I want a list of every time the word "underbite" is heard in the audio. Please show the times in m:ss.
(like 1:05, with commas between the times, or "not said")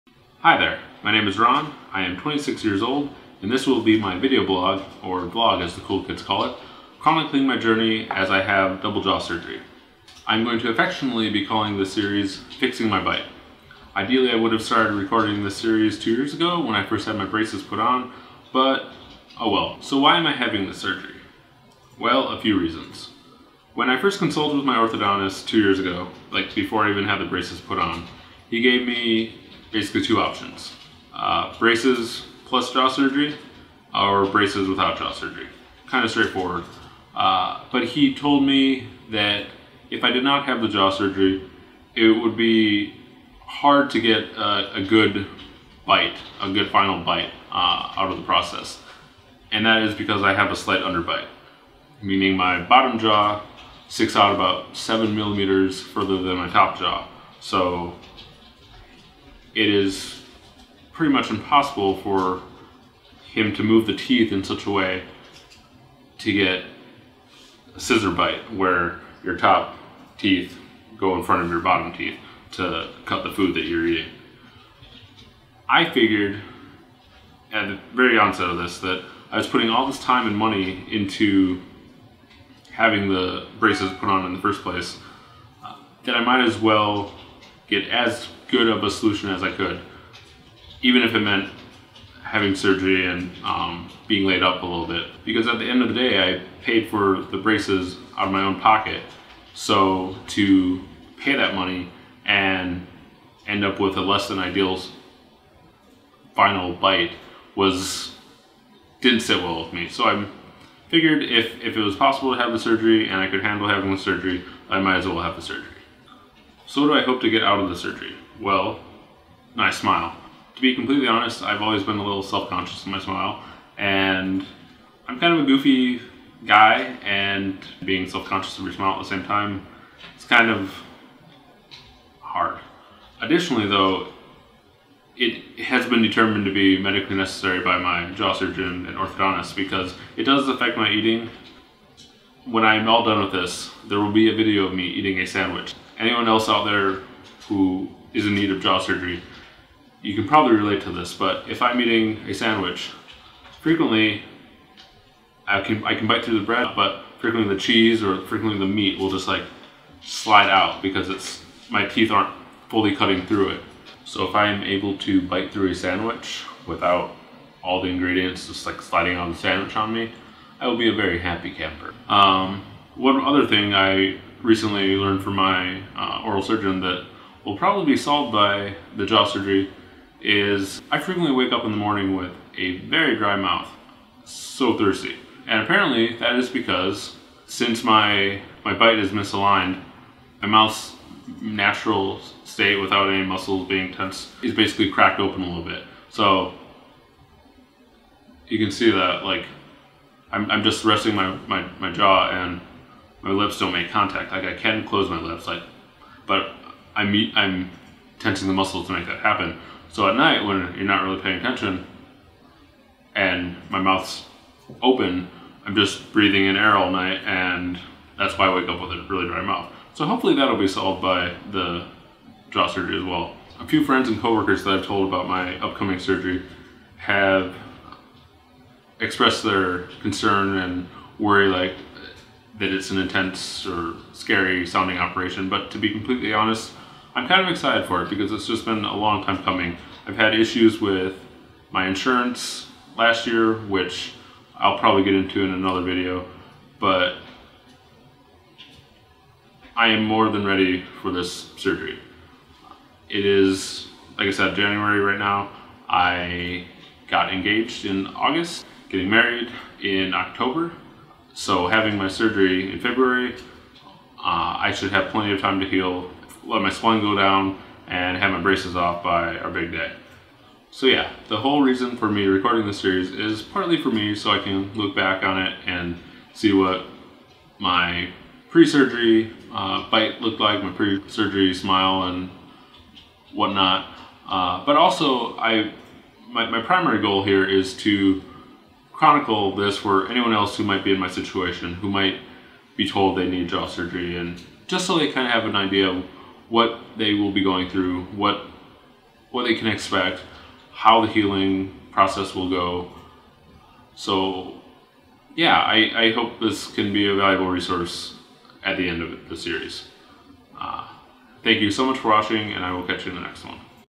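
0:50.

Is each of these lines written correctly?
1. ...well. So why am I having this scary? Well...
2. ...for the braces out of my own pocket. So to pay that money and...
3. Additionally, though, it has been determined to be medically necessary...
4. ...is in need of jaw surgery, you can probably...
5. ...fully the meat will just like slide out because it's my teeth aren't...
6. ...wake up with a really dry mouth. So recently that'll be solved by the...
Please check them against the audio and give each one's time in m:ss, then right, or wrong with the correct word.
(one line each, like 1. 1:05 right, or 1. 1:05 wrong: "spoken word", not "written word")
1. 0:19 wrong: "surgery", not "scary"
2. 1:36 right
3. 2:13 right
4. 2:28 right
5. 2:38 wrong: "frequently", not "fully"
6. 3:38 wrong: "hopefully", not "recently".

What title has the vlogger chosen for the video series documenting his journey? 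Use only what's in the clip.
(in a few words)
Fixing My Bite.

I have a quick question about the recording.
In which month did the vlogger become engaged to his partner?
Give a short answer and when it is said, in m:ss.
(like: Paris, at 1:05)
August, at 4:18.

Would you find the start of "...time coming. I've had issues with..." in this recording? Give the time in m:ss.
3:59.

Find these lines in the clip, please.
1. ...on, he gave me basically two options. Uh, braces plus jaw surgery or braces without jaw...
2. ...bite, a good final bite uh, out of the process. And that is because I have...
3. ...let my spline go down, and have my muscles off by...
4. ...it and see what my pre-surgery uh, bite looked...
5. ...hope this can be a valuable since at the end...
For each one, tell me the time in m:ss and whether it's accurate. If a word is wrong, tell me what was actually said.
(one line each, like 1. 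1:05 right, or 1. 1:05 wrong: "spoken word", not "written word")
1. 0:27 right
2. 0:45 right
3. 4:26 wrong: "braces", not "muscles"
4. 4:35 right
5. 5:06 wrong: "resource", not "since".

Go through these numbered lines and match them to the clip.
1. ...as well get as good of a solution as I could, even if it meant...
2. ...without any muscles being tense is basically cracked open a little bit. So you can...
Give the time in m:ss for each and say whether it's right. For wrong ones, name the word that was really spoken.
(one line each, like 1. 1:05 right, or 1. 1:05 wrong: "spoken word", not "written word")
1. 1:26 right
2. 3:12 right.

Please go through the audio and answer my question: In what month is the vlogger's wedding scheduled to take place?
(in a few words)
October.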